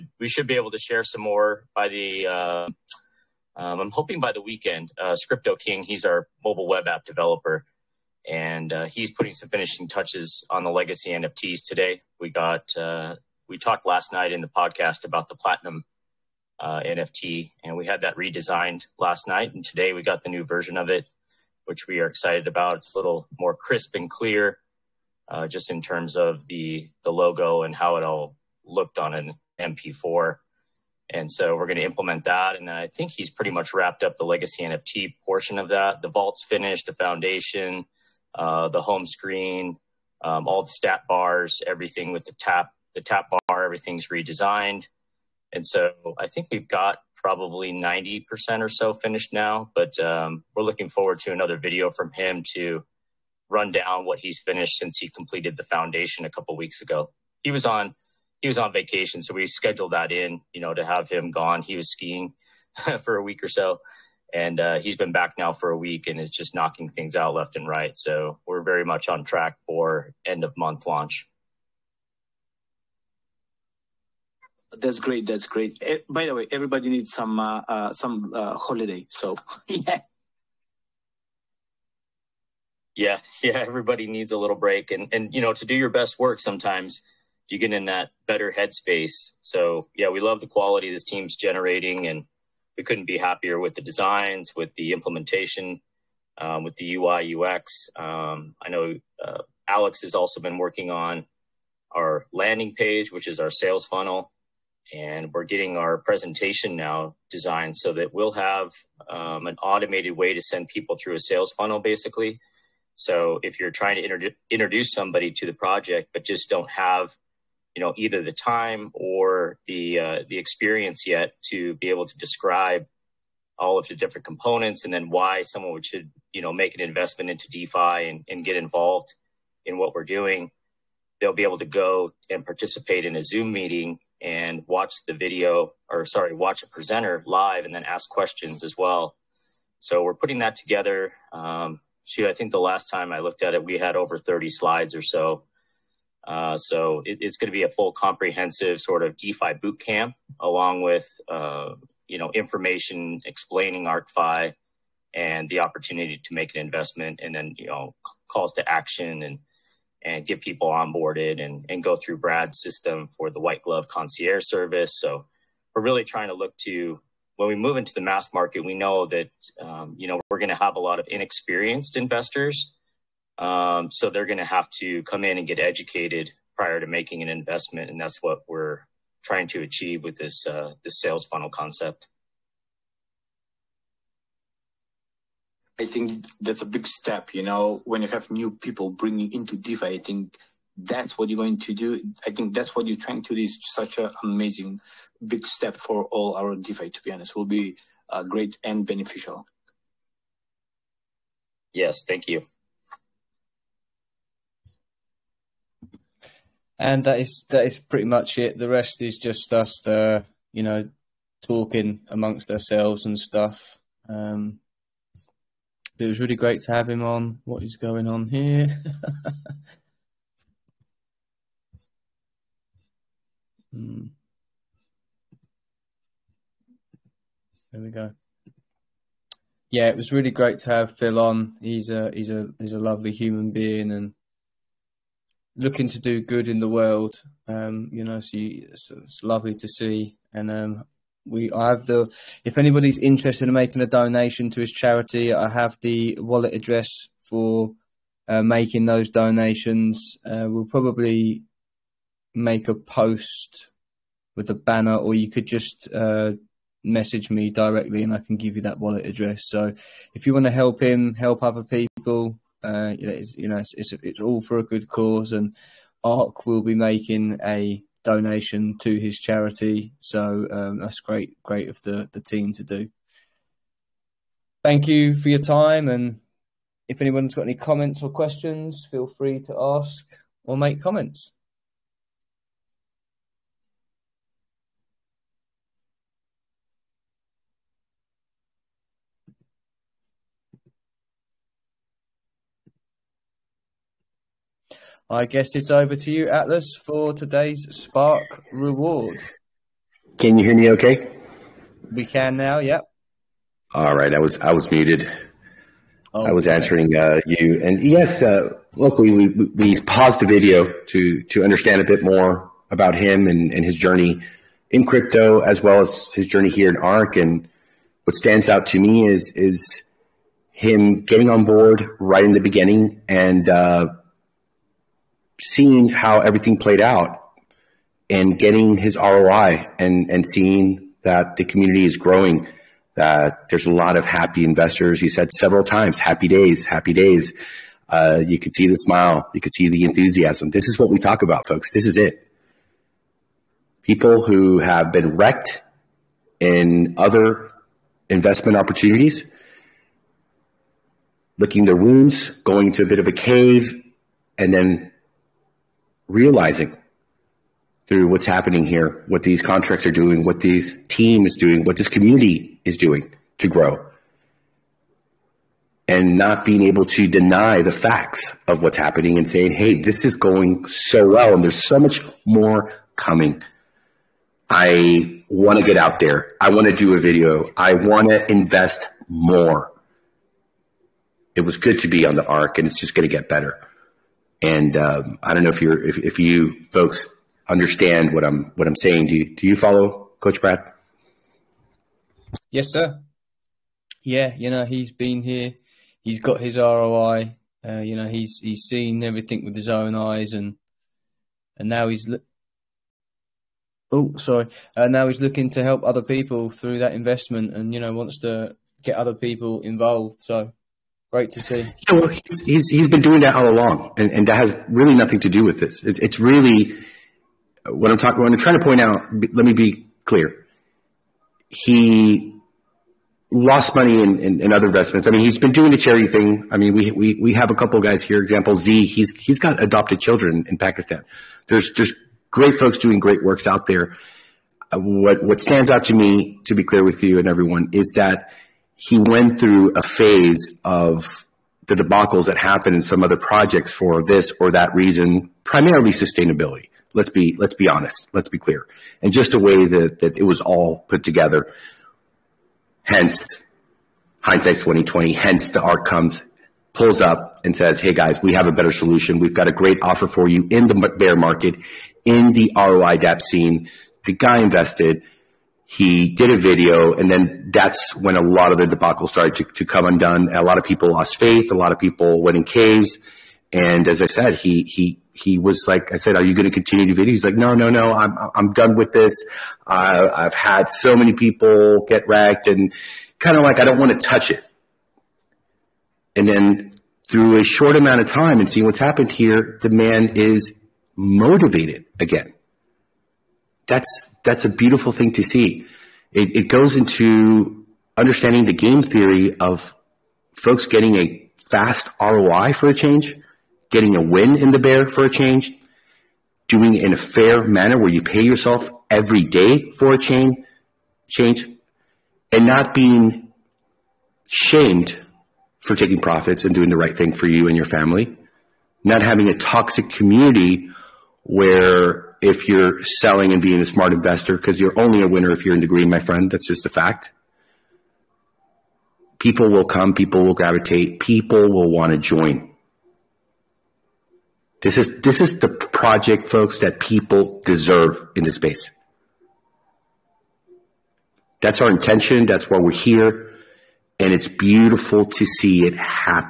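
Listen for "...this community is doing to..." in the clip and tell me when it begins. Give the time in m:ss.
6:01.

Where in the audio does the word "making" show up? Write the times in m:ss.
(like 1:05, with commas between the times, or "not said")
2:56, 4:03, 4:08, 4:26.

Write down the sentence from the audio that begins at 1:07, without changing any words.
So we're very much on track for end of month launch.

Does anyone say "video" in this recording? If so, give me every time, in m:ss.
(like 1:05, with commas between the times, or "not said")
0:51, 2:15, 5:10, 6:16, 7:46, 7:56.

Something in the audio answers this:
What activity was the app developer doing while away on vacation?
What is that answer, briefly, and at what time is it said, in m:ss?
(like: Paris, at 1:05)
Skiing, at 1:01.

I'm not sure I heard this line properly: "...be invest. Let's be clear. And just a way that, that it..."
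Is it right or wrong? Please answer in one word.
wrong.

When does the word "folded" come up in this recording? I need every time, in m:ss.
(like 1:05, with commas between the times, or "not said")
not said.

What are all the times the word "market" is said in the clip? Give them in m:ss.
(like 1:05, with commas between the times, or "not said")
2:48, 7:41.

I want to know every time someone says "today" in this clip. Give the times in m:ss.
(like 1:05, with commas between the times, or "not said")
0:11, 0:19, 4:57.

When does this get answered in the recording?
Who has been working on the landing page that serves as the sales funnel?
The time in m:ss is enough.
1:39.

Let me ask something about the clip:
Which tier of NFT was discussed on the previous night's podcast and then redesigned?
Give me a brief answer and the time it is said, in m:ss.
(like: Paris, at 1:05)
Platinum, at 0:15.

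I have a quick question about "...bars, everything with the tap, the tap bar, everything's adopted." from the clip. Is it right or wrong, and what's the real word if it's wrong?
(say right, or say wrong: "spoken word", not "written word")
wrong: "redesigned", not "adopted".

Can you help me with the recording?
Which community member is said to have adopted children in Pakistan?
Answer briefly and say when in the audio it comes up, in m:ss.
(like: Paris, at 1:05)
Z, at 7:08.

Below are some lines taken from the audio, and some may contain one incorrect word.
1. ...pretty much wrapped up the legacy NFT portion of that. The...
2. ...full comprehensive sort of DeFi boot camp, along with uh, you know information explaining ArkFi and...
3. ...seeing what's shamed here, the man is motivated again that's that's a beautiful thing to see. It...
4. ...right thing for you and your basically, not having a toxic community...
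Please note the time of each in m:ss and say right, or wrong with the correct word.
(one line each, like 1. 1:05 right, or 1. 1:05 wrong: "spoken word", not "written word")
1. 0:33 right
2. 2:27 right
3. 8:08 wrong: "happened", not "shamed"
4. 8:36 wrong: "family", not "basically".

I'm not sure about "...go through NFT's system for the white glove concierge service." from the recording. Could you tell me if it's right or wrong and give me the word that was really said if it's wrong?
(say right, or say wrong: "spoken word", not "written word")
wrong: "Brad", not "NFT".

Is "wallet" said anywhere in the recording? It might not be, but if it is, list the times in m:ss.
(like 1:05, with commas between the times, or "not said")
4:06, 4:18.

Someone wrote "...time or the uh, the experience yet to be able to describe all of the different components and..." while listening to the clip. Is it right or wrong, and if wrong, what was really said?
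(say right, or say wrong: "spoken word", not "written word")
right.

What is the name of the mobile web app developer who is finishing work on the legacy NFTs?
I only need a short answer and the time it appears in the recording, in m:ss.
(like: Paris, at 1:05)
Scripto King, at 0:05.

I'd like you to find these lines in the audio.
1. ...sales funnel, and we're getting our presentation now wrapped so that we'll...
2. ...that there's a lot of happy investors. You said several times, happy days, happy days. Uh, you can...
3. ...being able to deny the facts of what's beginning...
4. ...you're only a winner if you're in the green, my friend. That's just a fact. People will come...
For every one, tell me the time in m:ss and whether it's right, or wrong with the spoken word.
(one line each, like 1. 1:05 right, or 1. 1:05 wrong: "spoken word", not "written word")
1. 1:43 wrong: "designed", not "wrapped"
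2. 5:32 right
3. 6:06 wrong: "happening", not "beginning"
4. 8:44 right.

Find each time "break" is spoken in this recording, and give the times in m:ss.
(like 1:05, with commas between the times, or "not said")
1:24.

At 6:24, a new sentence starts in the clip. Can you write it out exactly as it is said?
And um, I don't know if you if, if you folks understand what I'm what I'm saying.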